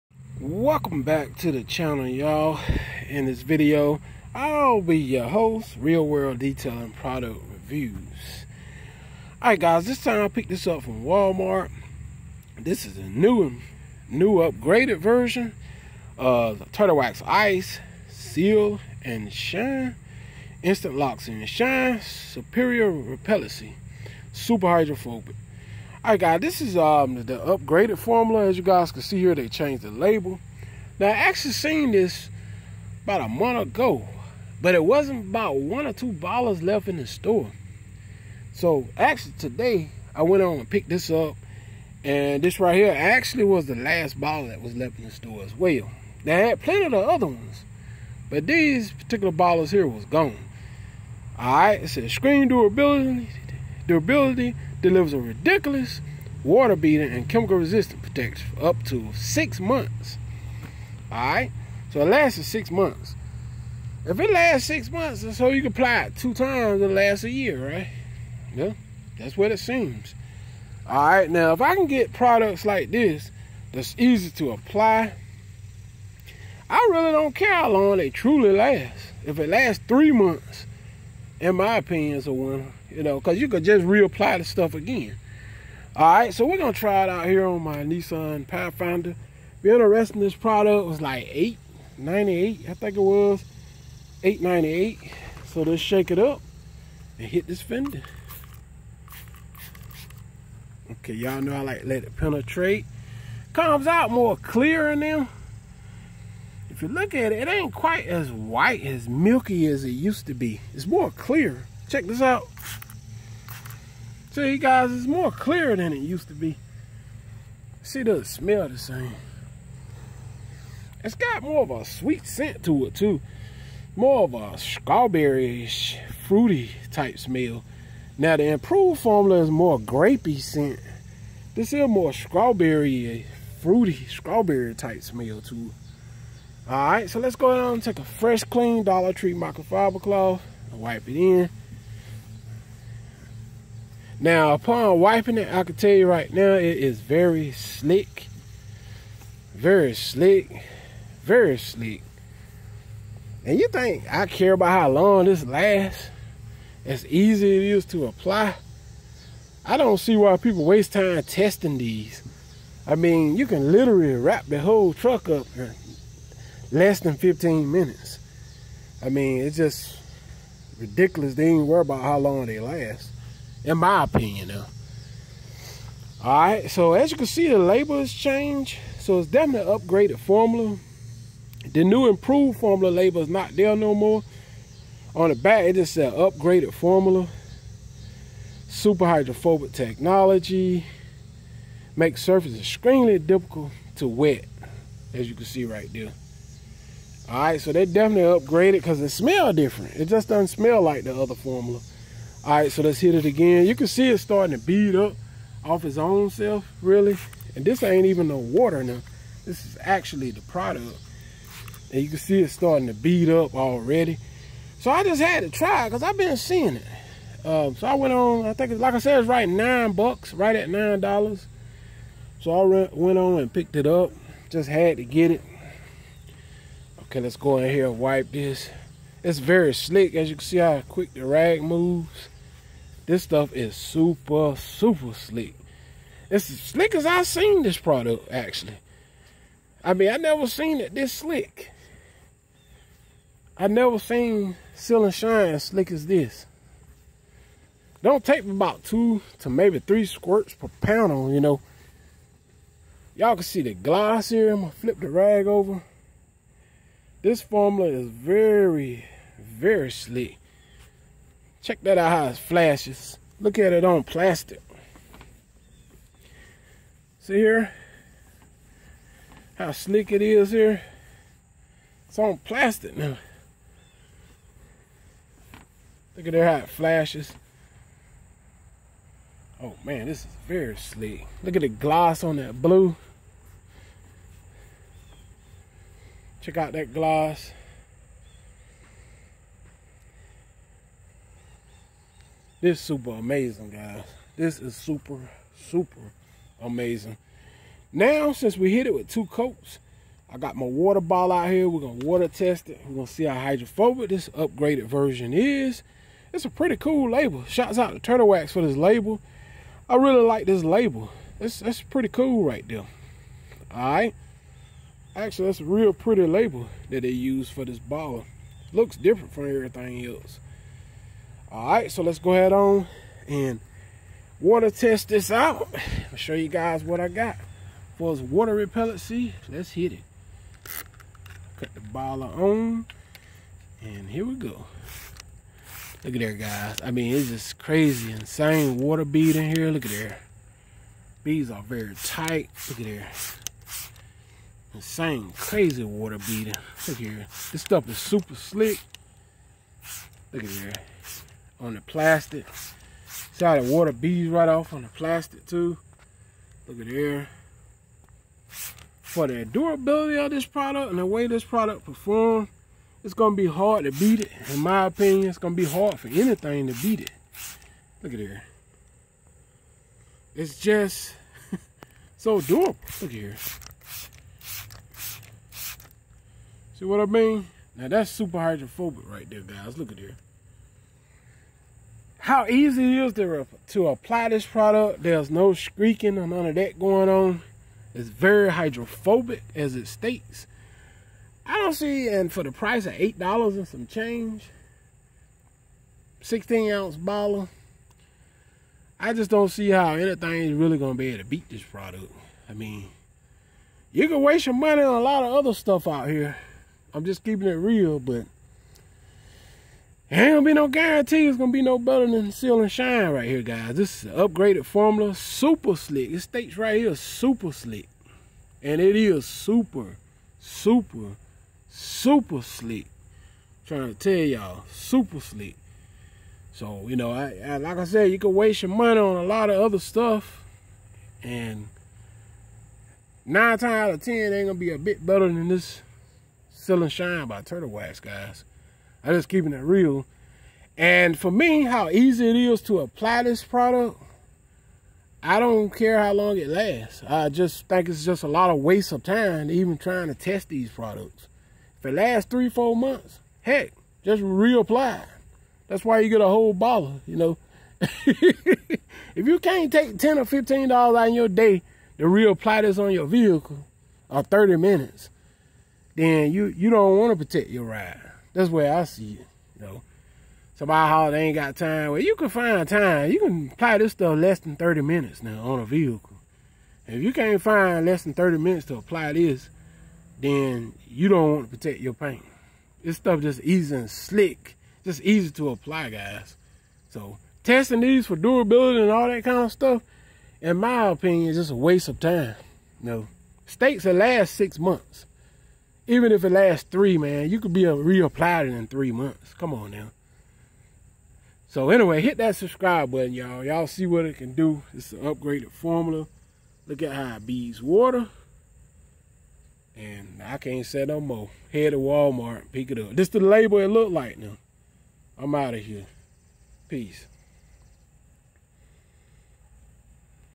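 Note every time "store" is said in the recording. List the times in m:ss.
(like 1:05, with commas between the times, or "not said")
0:37, 0:45.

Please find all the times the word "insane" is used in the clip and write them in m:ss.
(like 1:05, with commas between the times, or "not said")
5:38, 5:44.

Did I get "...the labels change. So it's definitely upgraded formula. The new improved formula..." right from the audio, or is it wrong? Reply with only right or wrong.
right.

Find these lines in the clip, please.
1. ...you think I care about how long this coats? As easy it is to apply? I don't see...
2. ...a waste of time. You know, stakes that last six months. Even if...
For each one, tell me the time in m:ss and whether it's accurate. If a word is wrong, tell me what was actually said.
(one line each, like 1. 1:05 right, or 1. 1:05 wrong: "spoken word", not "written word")
1. 2:33 wrong: "lasts", not "coats"
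2. 8:11 right.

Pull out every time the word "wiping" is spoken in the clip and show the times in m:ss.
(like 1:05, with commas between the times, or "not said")
2:24.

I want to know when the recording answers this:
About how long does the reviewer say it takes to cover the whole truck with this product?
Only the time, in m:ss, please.
2:46.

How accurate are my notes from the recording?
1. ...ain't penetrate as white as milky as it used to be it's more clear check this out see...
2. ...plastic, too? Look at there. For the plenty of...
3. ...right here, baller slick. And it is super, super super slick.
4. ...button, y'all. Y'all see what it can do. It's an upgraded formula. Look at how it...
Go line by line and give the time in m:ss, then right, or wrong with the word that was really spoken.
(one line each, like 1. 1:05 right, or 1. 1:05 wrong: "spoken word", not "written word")
1. 1:47 wrong: "quite", not "penetrate"
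2. 5:54 wrong: "durability", not "plenty"
3. 6:56 wrong: "super", not "baller"
4. 8:22 right.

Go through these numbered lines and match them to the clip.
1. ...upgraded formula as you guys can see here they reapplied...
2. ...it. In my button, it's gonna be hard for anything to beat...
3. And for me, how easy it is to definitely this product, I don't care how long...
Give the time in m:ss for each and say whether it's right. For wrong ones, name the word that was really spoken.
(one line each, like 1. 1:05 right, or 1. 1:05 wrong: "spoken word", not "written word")
1. 0:27 wrong: "changed", not "reapplied"
2. 6:04 wrong: "opinion", not "button"
3. 7:20 wrong: "apply", not "definitely".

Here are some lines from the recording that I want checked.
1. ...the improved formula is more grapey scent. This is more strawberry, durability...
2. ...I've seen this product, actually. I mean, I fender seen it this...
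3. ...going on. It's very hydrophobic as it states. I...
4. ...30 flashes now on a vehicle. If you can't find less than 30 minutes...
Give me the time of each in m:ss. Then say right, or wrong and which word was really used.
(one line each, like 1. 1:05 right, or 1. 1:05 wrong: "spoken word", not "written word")
1. 2:08 wrong: "fruity", not "durability"
2. 3:57 wrong: "never", not "fender"
3. 6:26 right
4. 7:54 wrong: "minutes", not "flashes".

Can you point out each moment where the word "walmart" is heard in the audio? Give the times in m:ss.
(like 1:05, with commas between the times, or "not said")
0:11, 8:31.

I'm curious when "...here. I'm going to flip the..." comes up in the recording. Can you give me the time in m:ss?
4:14.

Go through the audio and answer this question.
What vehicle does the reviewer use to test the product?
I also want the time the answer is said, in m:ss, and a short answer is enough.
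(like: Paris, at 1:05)
Nissan Pathfinder, at 1:27.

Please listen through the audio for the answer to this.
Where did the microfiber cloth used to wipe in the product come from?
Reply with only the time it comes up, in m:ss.
2:18.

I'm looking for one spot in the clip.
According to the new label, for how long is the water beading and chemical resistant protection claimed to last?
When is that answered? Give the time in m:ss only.
0:58.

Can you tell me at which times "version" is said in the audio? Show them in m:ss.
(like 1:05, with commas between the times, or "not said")
0:14, 5:04.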